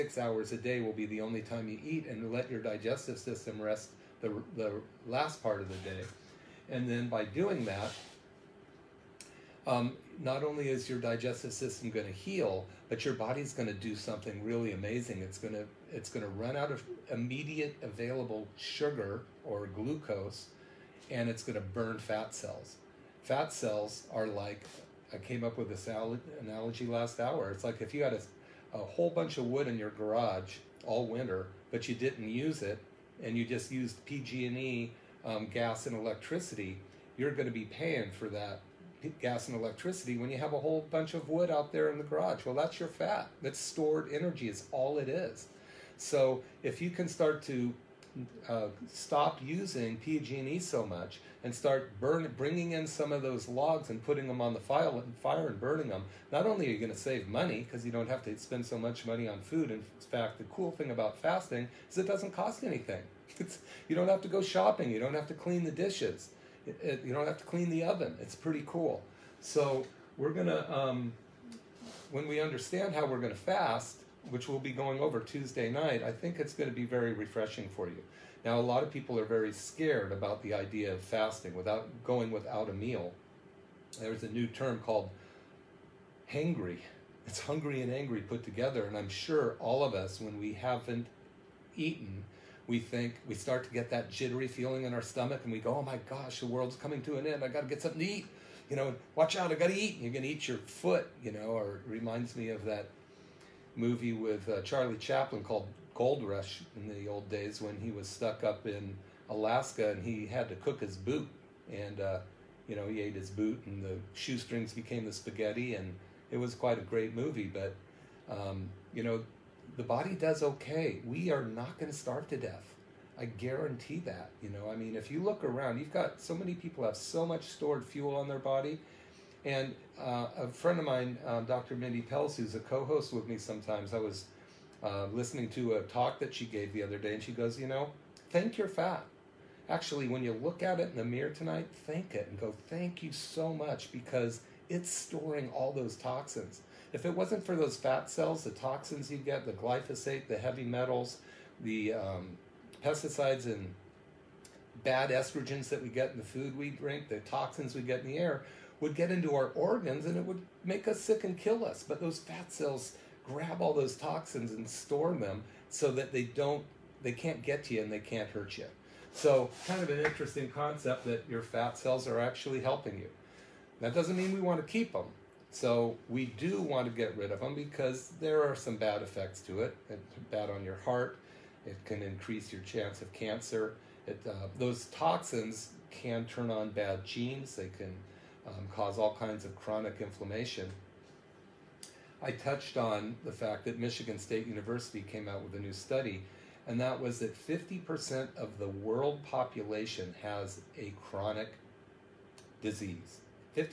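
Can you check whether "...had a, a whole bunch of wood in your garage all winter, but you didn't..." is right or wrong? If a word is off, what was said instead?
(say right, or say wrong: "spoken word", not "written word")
right.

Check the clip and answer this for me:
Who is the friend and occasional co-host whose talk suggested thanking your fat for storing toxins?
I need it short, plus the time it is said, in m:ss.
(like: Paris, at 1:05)
Dr. Mindy Pelz, at 2:11.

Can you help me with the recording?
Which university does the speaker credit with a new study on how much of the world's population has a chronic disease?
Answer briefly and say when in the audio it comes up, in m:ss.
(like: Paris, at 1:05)
Michigan State University, at 3:13.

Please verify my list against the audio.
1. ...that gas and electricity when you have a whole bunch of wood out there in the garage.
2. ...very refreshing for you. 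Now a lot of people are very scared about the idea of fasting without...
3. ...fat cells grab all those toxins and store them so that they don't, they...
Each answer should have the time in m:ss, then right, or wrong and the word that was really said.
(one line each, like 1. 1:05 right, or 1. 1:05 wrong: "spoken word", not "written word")
1. 0:38 right
2. 1:16 right
3. 2:42 right.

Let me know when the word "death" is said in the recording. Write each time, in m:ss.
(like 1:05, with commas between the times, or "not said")
2:02.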